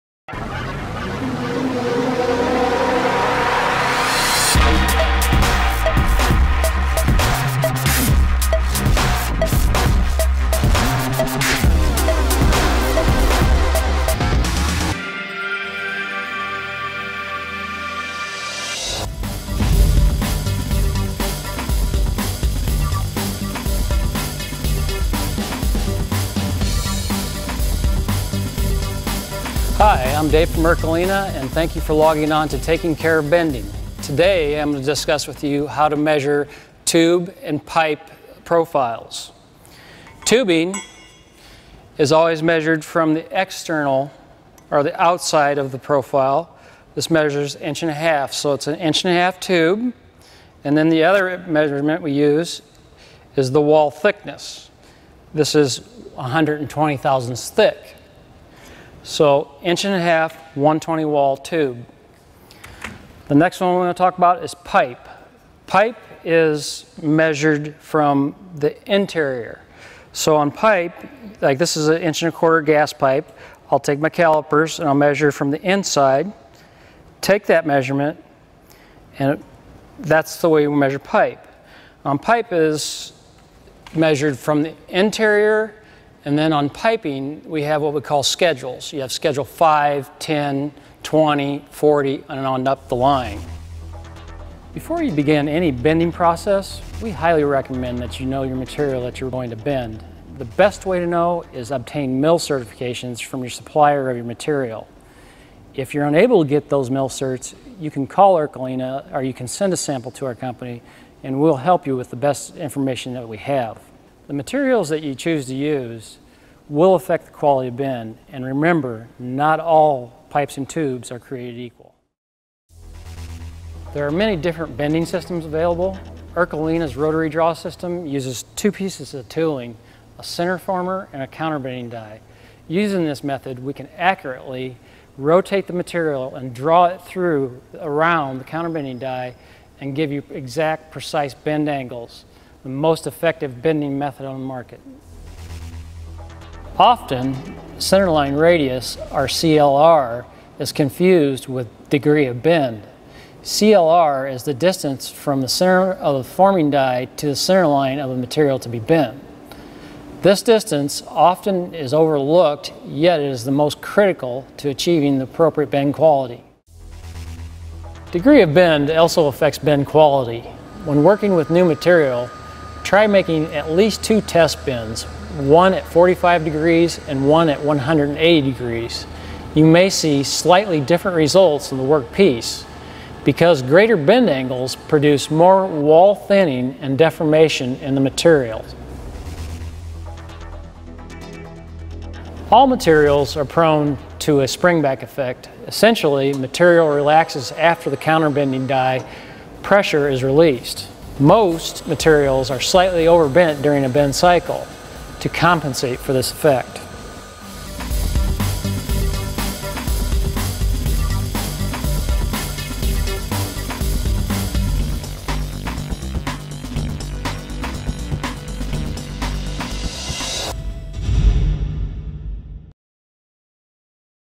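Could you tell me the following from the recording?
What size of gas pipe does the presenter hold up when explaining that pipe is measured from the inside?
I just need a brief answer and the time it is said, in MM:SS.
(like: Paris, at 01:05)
1 1/4 inch, at 01:12.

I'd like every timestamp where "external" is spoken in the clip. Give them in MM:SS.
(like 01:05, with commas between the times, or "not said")
00:43.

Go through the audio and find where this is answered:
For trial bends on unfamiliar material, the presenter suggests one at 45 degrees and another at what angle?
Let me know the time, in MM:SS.
02:57.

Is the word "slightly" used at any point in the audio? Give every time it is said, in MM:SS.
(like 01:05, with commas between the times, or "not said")
03:00, 03:22.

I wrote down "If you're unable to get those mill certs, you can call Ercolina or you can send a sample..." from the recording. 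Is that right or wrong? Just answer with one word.
right.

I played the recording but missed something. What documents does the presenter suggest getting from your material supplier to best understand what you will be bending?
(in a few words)
mill certifications.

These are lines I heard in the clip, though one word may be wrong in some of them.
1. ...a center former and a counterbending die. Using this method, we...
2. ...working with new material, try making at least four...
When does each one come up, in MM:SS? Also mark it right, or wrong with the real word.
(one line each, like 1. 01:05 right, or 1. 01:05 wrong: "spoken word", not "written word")
1. 02:10 right
2. 02:51 wrong: "two", not "four".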